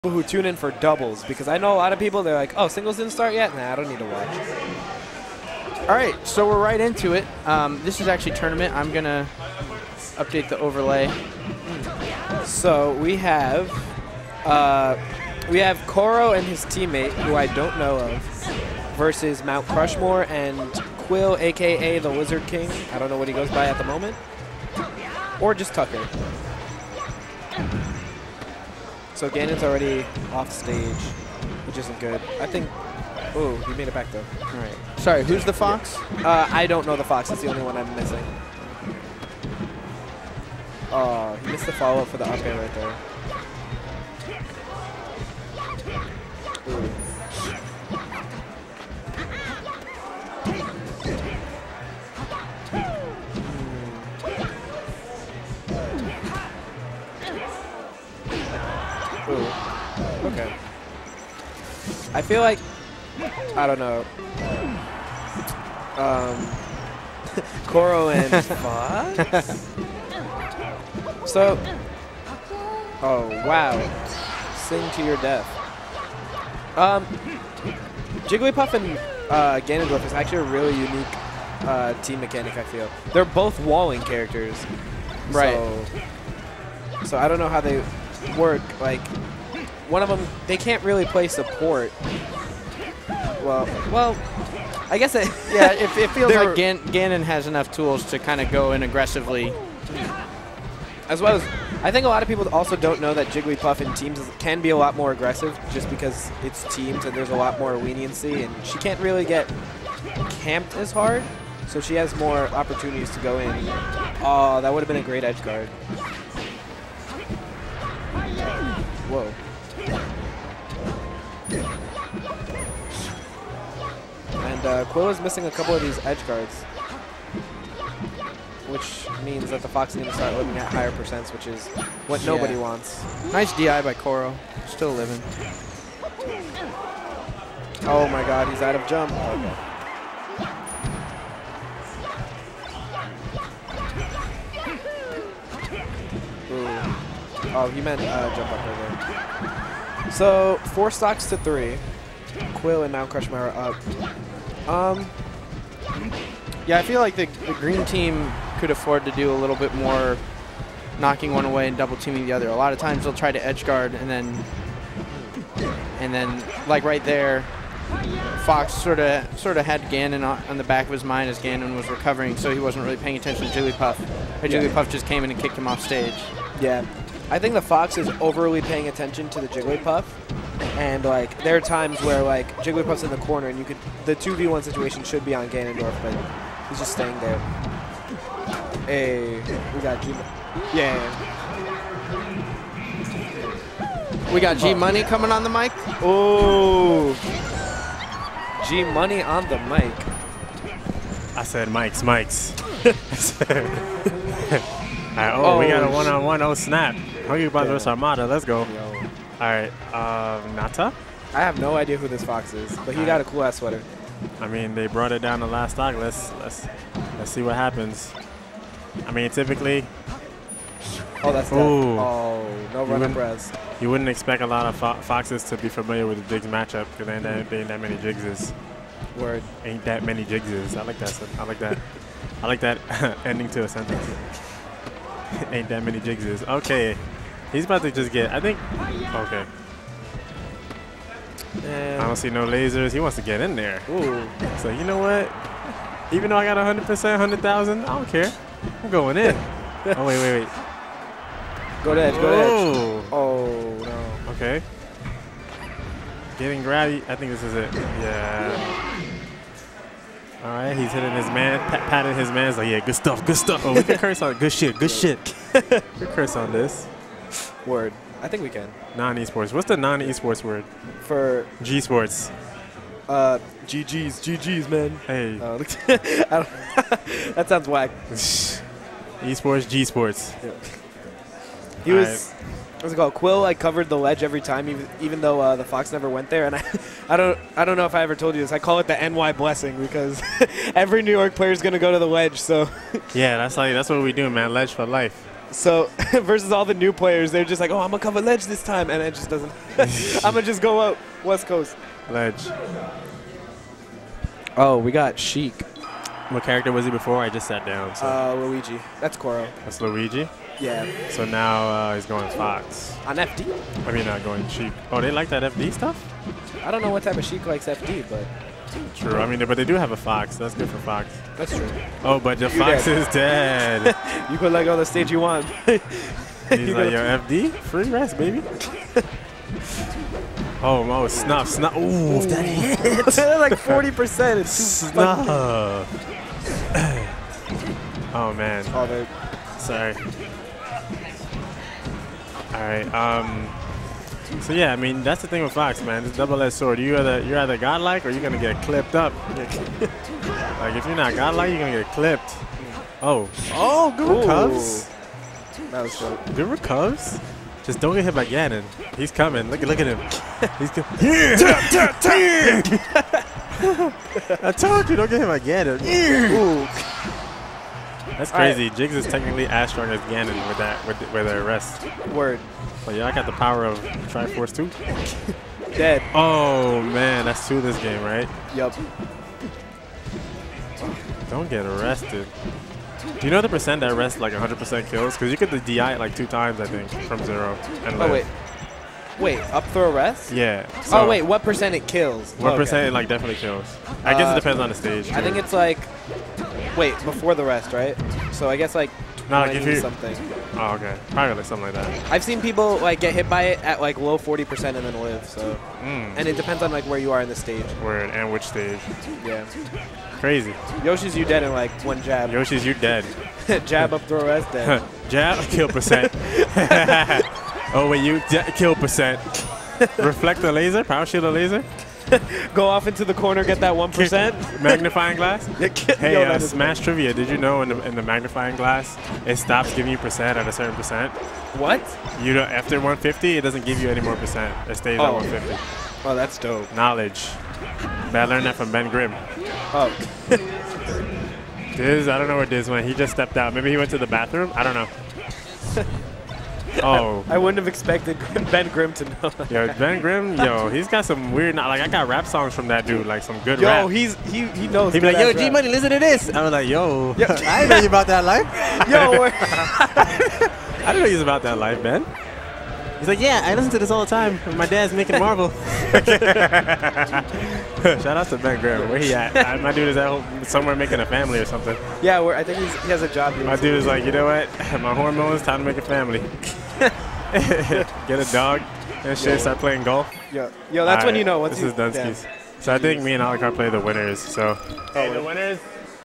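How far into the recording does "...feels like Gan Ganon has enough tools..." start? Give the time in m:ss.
1:36.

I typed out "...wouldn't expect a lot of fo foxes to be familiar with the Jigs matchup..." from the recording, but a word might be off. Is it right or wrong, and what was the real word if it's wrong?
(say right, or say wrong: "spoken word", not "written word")
right.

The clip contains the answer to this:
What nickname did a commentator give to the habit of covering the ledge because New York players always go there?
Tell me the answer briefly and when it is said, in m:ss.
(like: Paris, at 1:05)
NY blessing, at 4:49.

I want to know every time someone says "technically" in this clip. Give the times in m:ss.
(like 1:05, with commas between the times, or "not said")
6:09.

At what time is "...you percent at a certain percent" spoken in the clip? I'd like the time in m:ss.
7:09.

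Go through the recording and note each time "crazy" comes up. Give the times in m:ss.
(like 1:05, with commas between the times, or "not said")
6:08, 6:50.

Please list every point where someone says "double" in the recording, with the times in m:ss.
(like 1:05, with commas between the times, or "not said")
0:00, 2:41, 5:46.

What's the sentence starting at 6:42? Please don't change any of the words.
I've seen people like get hit by it at like low 40% and then live.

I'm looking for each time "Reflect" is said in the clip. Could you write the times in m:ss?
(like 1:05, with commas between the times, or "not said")
6:59.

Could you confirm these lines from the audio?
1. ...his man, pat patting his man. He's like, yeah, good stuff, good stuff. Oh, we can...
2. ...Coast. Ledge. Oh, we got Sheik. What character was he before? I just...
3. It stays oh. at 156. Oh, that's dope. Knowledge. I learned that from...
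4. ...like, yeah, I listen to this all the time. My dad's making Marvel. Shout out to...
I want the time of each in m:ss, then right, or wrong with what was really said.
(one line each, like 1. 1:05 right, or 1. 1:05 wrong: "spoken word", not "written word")
1. 4:21 right
2. 5:01 right
3. 7:14 wrong: "150", not "156"
4. 7:43 right.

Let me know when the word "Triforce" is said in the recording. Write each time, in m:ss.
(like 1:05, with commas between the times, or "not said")
6:13.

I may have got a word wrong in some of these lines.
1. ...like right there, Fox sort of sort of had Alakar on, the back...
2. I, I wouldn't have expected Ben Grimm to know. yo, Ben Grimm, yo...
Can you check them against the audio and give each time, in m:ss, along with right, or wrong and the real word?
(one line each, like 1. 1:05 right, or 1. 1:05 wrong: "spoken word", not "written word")
1. 2:46 wrong: "Ganon", not "Alakar"
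2. 7:27 right.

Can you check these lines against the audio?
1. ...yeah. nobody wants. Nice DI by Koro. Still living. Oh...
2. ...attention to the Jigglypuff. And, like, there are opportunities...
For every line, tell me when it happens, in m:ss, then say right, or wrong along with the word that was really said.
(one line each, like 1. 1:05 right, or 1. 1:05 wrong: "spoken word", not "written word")
1. 2:12 right
2. 2:58 wrong: "times", not "opportunities".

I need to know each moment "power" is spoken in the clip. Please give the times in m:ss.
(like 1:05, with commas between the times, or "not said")
6:13, 7:00.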